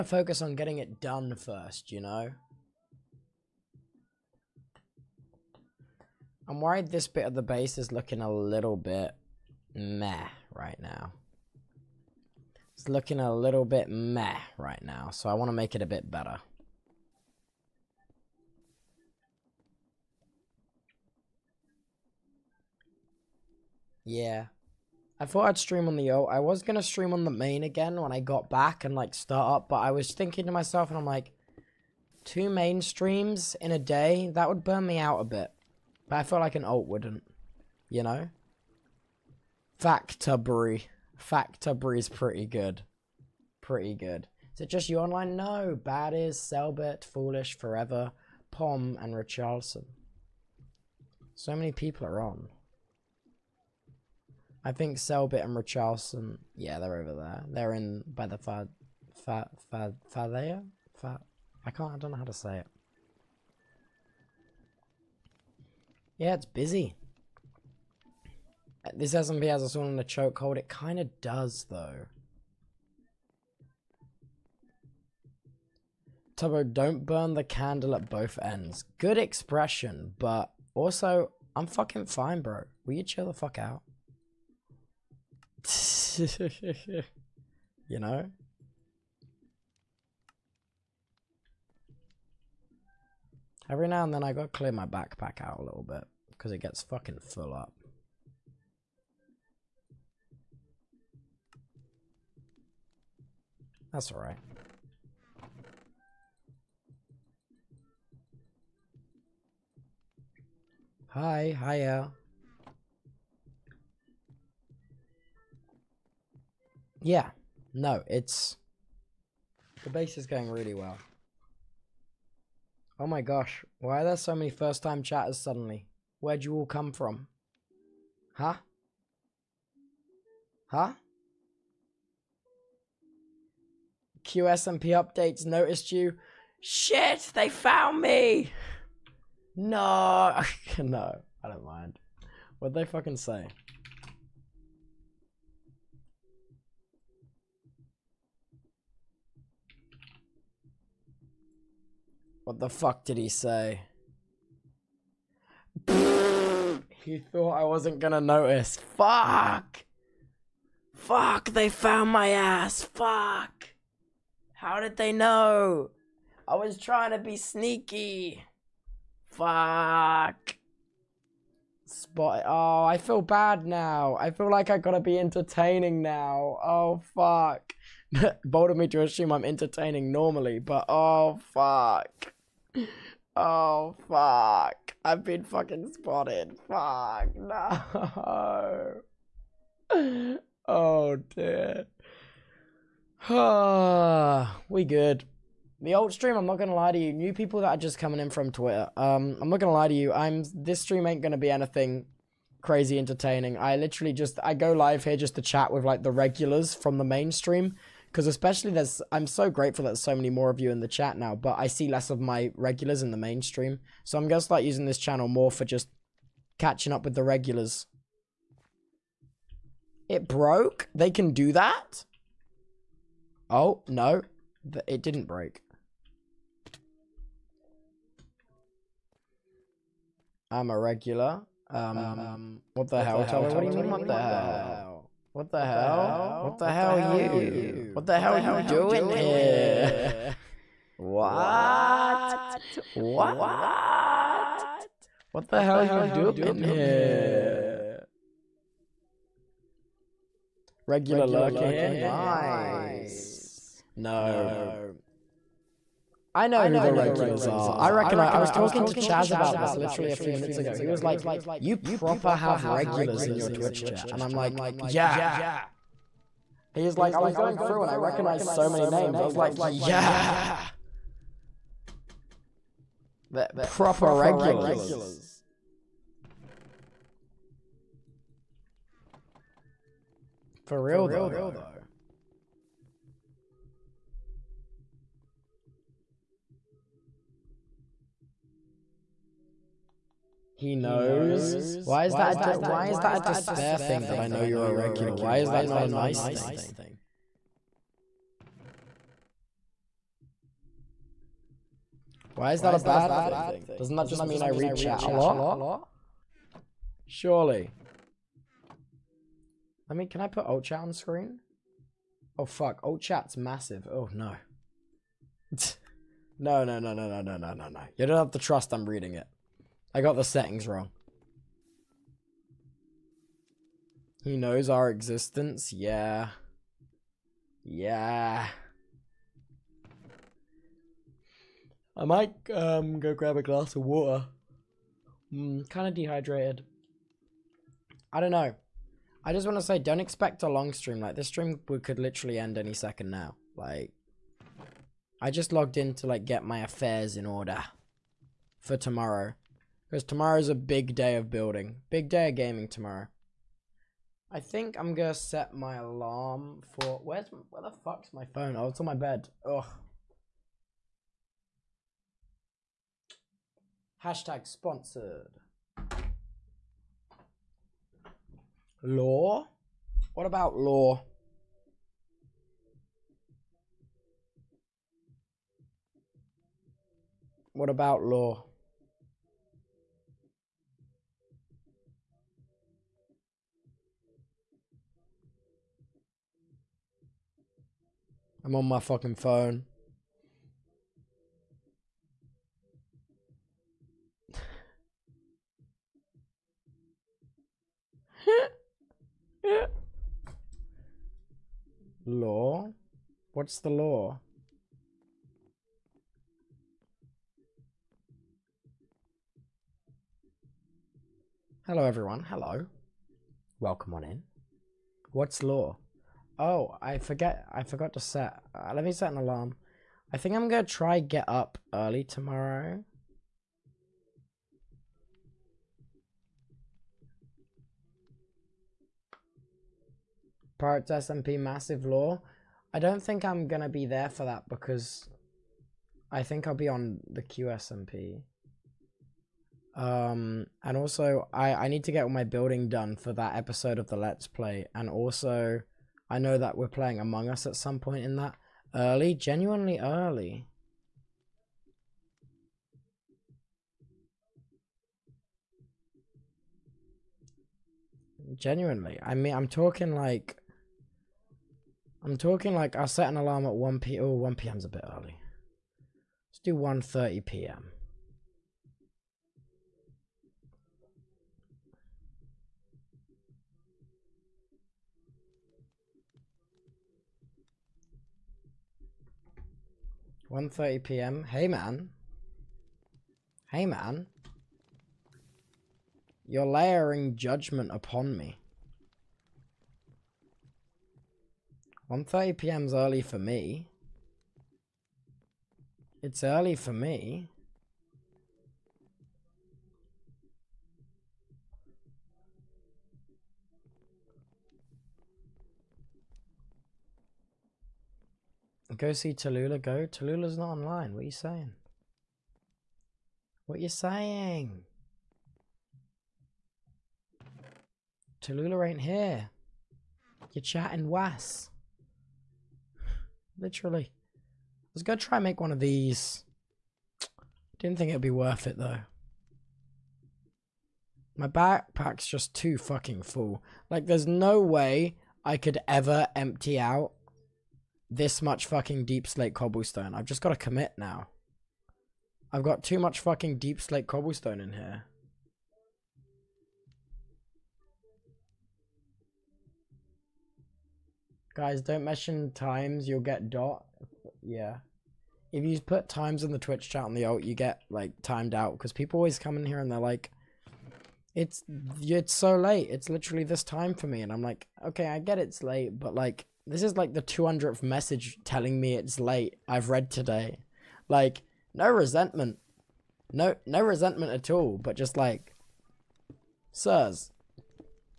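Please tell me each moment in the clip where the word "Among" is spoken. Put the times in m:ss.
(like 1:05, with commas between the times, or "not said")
7:26.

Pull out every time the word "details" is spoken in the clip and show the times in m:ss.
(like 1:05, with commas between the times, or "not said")
not said.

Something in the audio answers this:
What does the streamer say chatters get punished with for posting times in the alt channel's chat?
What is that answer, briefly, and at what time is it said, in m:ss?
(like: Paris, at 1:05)
Timed out, at 9:18.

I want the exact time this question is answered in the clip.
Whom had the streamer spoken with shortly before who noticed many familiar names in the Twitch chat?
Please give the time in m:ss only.
4:18.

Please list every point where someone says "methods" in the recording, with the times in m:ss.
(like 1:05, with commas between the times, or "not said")
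not said.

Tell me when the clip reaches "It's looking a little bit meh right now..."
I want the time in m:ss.
0:12.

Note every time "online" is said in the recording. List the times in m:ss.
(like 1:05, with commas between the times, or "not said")
0:44, 8:30.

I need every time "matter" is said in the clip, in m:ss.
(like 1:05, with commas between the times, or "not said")
not said.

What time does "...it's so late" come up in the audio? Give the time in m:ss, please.
9:21.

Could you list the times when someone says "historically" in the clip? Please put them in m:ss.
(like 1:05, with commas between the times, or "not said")
not said.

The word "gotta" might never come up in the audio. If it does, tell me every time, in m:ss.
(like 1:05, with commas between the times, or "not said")
1:34, 2:54.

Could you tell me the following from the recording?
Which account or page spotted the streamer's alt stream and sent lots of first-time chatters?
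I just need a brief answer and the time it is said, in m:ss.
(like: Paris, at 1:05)
QSMP updates, at 2:14.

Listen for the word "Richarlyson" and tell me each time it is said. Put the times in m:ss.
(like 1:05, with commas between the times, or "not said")
0:49, 0:55.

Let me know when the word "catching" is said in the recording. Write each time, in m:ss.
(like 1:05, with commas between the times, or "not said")
3:36.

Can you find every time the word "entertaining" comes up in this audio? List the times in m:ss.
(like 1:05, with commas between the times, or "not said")
2:55, 2:59, 3:22.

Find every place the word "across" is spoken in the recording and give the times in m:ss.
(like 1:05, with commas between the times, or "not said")
not said.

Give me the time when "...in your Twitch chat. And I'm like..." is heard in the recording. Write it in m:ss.
4:23.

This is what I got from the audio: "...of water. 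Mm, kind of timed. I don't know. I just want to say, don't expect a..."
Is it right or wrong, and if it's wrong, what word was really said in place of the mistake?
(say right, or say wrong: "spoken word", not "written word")
wrong: "dehydrated", not "timed".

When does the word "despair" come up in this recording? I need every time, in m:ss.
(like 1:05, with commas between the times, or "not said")
4:53.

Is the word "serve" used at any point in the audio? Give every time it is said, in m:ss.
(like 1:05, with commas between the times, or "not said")
not said.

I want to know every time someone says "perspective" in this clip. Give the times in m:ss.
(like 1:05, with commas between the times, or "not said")
not said.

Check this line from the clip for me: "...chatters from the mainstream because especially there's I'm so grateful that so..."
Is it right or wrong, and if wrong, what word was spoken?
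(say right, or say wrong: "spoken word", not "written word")
wrong: "regulars", not "chatters".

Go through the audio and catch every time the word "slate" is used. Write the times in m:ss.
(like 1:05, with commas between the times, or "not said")
8:59, 9:03.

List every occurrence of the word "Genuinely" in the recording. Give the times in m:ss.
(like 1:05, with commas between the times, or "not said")
7:29, 7:38.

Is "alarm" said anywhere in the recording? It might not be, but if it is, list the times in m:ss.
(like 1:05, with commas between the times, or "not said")
5:55, 6:59, 7:43.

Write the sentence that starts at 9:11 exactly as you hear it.
Guys, don't mention times, you'll get dot.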